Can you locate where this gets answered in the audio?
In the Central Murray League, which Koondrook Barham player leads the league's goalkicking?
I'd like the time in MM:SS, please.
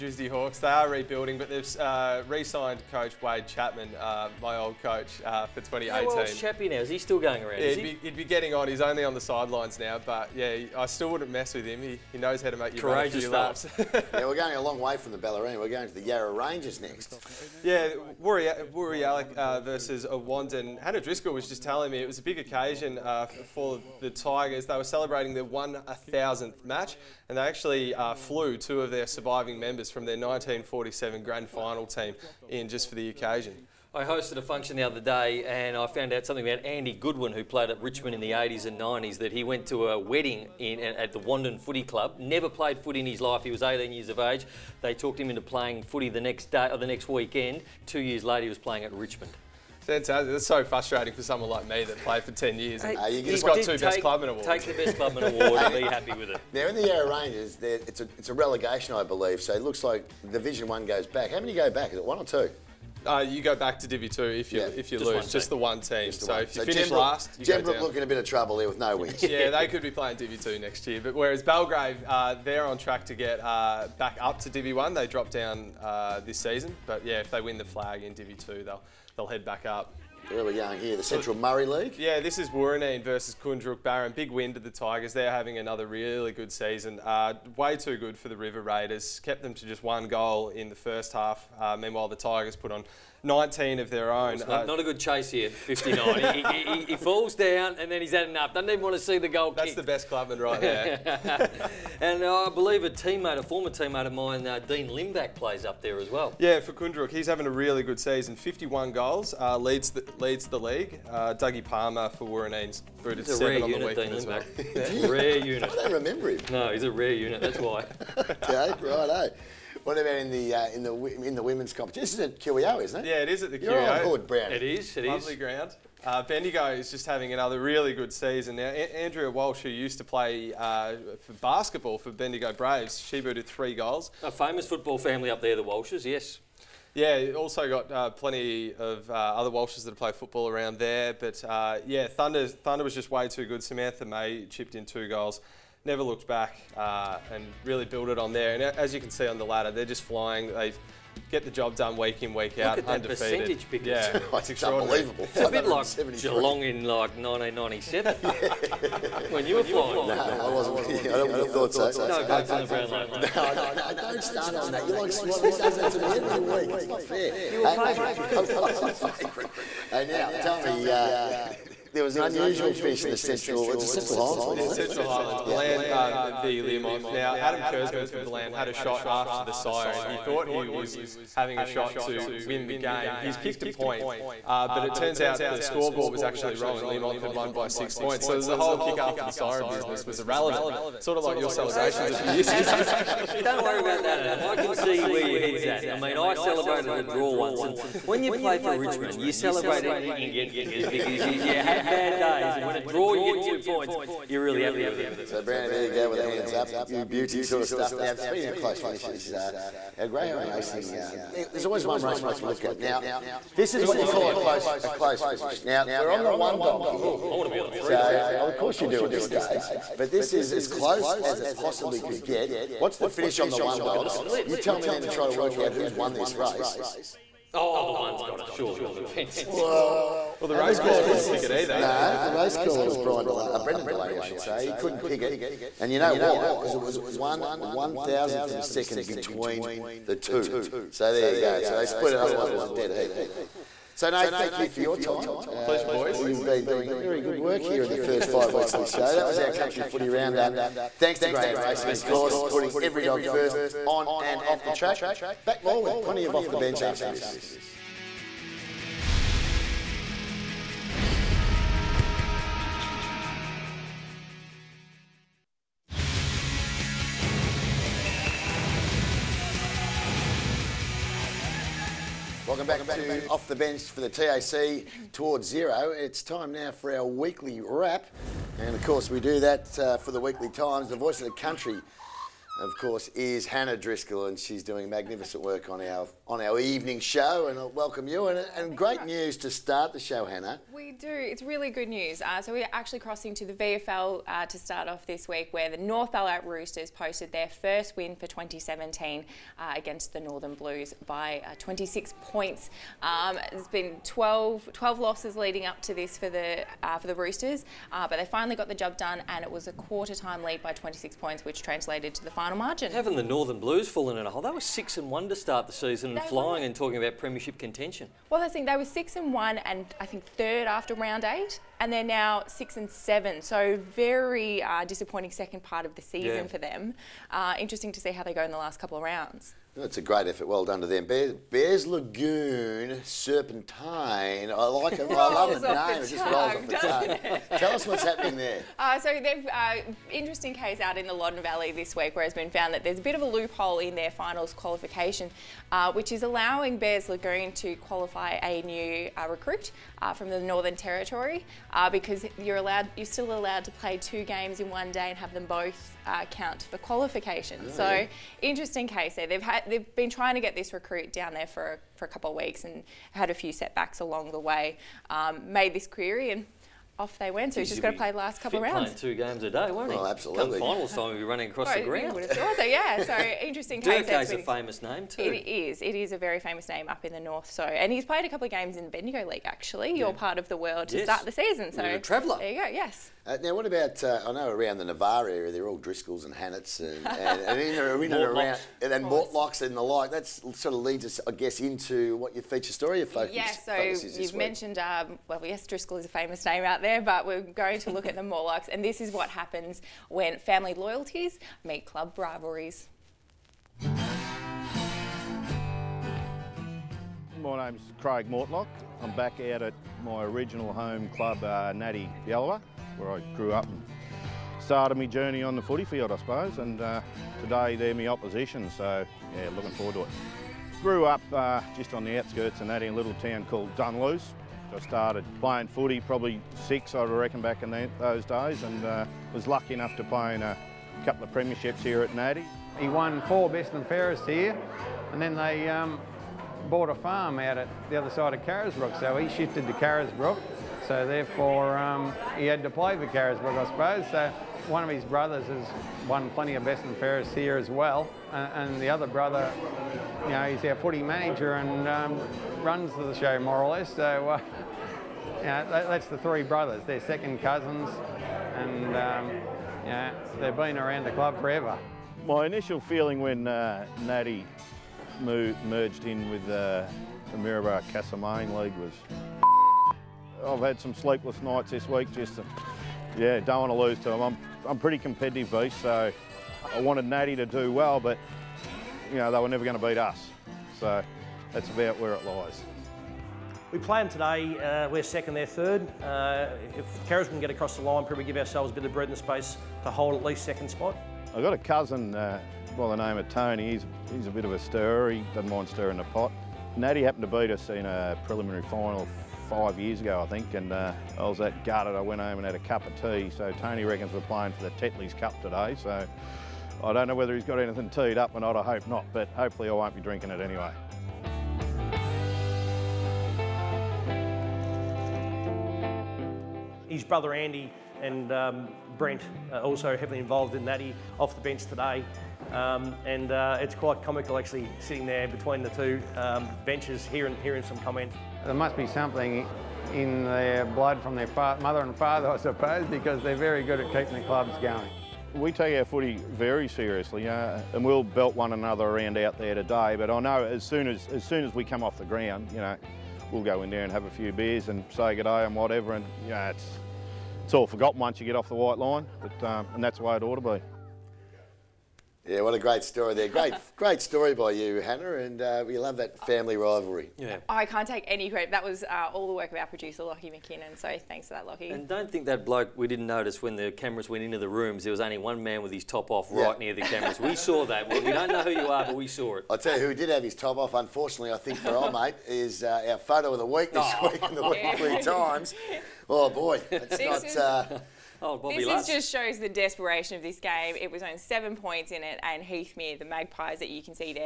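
01:44.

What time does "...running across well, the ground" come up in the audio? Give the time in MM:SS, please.
06:11.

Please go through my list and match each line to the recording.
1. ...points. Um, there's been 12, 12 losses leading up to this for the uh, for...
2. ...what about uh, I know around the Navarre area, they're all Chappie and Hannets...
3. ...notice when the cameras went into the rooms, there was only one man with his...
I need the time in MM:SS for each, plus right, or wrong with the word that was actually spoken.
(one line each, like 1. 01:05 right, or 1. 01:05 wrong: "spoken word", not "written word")
1. 05:02 right
2. 06:23 wrong: "Driscolls", not "Chappie"
3. 09:23 right.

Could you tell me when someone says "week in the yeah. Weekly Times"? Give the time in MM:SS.
09:34.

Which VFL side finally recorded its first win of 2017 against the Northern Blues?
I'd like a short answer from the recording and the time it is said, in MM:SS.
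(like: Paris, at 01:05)
North Ballarat Roosters, at 04:55.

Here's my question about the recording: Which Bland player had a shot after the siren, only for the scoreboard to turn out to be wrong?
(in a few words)
Adam Kersman.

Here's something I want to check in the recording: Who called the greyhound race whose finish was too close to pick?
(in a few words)
Brendan Delaney.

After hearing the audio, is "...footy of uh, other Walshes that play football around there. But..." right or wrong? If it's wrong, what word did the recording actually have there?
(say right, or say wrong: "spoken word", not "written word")
wrong: "plenty", not "footy".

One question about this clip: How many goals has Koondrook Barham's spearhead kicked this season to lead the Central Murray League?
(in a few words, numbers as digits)
51.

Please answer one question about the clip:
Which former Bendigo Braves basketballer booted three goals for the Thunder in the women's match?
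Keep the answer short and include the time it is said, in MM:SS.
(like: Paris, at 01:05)
Andrea Walsh, at 02:09.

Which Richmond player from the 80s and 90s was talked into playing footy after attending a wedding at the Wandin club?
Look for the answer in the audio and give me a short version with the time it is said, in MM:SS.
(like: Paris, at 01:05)
Andy Goodwin, at 00:36.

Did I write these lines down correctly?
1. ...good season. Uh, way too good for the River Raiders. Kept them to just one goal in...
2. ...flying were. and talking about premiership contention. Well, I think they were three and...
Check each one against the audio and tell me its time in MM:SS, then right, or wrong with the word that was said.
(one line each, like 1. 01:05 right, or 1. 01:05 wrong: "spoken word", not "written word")
1. 01:26 right
2. 05:16 wrong: "six", not "three".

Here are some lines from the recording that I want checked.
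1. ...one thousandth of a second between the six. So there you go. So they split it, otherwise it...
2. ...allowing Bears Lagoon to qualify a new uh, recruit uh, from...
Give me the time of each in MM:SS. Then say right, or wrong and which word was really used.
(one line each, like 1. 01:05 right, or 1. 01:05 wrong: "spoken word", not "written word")
1. 03:57 wrong: "two", not "six"
2. 05:46 right.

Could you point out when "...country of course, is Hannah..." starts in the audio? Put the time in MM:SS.
04:41.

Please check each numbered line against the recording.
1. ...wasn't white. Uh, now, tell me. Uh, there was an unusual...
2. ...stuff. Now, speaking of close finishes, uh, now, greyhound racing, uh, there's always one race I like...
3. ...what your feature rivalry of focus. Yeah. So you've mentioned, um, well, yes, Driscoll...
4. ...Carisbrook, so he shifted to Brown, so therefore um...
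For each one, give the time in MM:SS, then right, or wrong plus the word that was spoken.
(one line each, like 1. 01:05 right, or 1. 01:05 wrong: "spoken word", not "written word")
1. 02:48 wrong: "favourite", not "white"
2. 03:27 right
3. 06:32 wrong: "story", not "rivalry"
4. 07:18 wrong: "Carisbrook", not "Brown".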